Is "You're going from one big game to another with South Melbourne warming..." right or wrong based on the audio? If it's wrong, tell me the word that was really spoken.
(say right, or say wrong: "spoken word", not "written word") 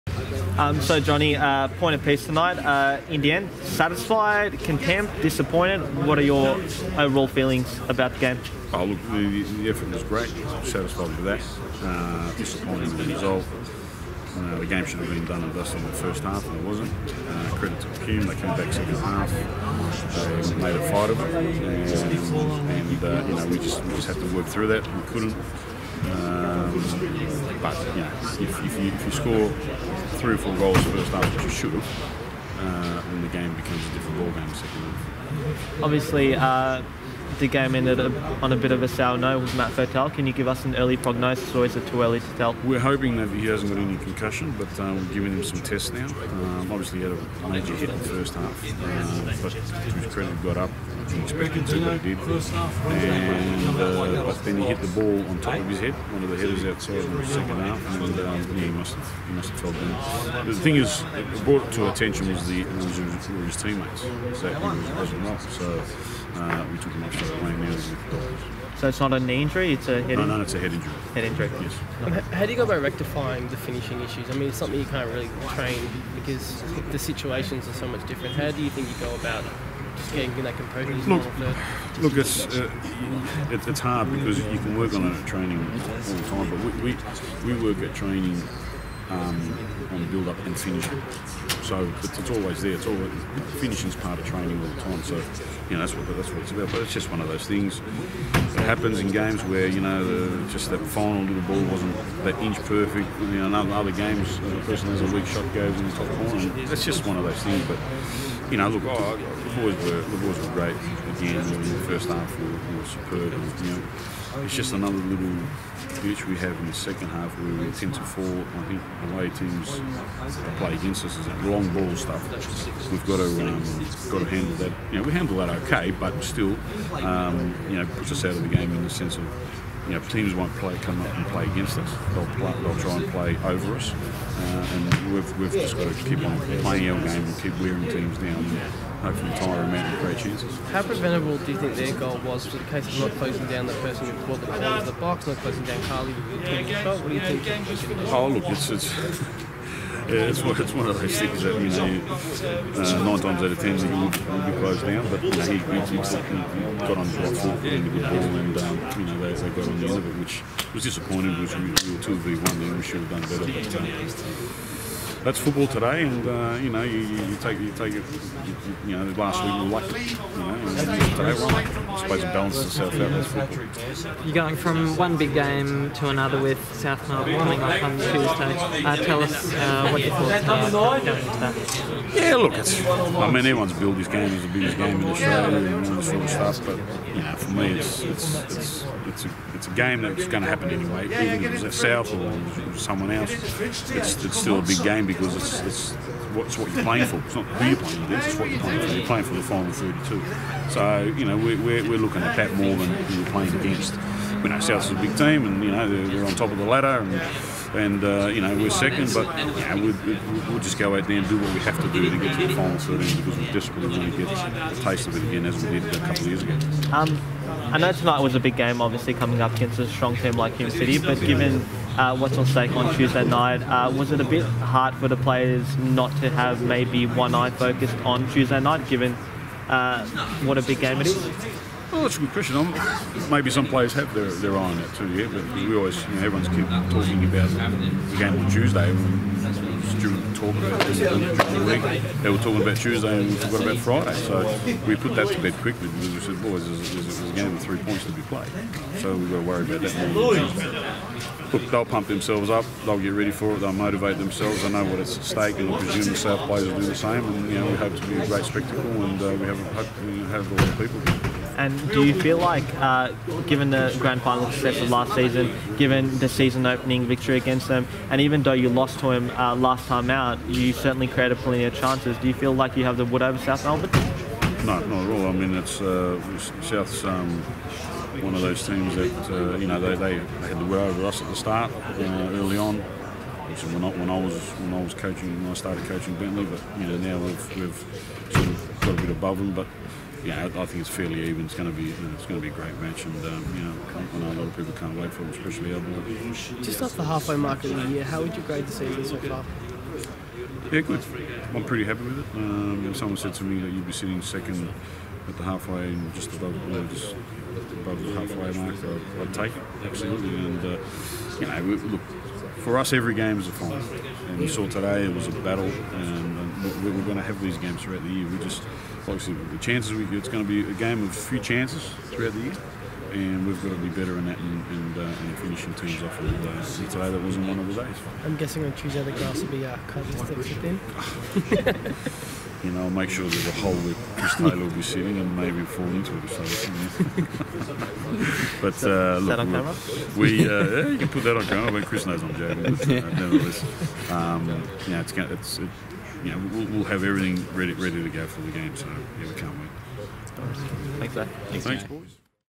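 right.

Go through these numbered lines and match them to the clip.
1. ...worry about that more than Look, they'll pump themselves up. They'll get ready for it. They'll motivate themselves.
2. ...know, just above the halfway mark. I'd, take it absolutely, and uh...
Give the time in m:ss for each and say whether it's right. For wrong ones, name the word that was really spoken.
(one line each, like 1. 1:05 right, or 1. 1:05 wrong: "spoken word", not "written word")
1. 4:09 right
2. 5:06 right.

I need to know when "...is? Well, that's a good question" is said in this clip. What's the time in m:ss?
3:51.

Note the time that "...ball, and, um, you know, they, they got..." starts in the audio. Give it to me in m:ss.
2:37.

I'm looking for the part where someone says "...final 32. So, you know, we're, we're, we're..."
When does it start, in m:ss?
3:19.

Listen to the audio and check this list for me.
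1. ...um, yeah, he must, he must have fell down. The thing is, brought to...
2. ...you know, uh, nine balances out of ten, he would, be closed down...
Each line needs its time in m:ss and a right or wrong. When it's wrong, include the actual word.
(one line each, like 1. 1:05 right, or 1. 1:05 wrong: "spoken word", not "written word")
1. 0:58 right
2. 2:31 wrong: "times", not "balances".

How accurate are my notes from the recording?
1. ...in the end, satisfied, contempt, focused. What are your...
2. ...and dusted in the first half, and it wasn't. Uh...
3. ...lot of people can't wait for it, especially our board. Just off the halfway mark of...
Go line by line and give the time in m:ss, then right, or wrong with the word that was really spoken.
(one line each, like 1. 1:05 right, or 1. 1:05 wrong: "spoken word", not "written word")
1. 0:03 wrong: "disappointed", not "focused"
2. 0:15 right
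3. 4:54 right.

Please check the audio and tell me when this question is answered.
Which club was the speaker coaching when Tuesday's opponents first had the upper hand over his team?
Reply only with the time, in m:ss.
4:46.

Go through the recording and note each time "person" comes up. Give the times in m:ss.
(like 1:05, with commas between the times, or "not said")
1:44, 2:23.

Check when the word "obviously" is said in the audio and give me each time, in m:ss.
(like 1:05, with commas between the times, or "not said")
0:35, 0:46, 3:38, 4:43, 5:19.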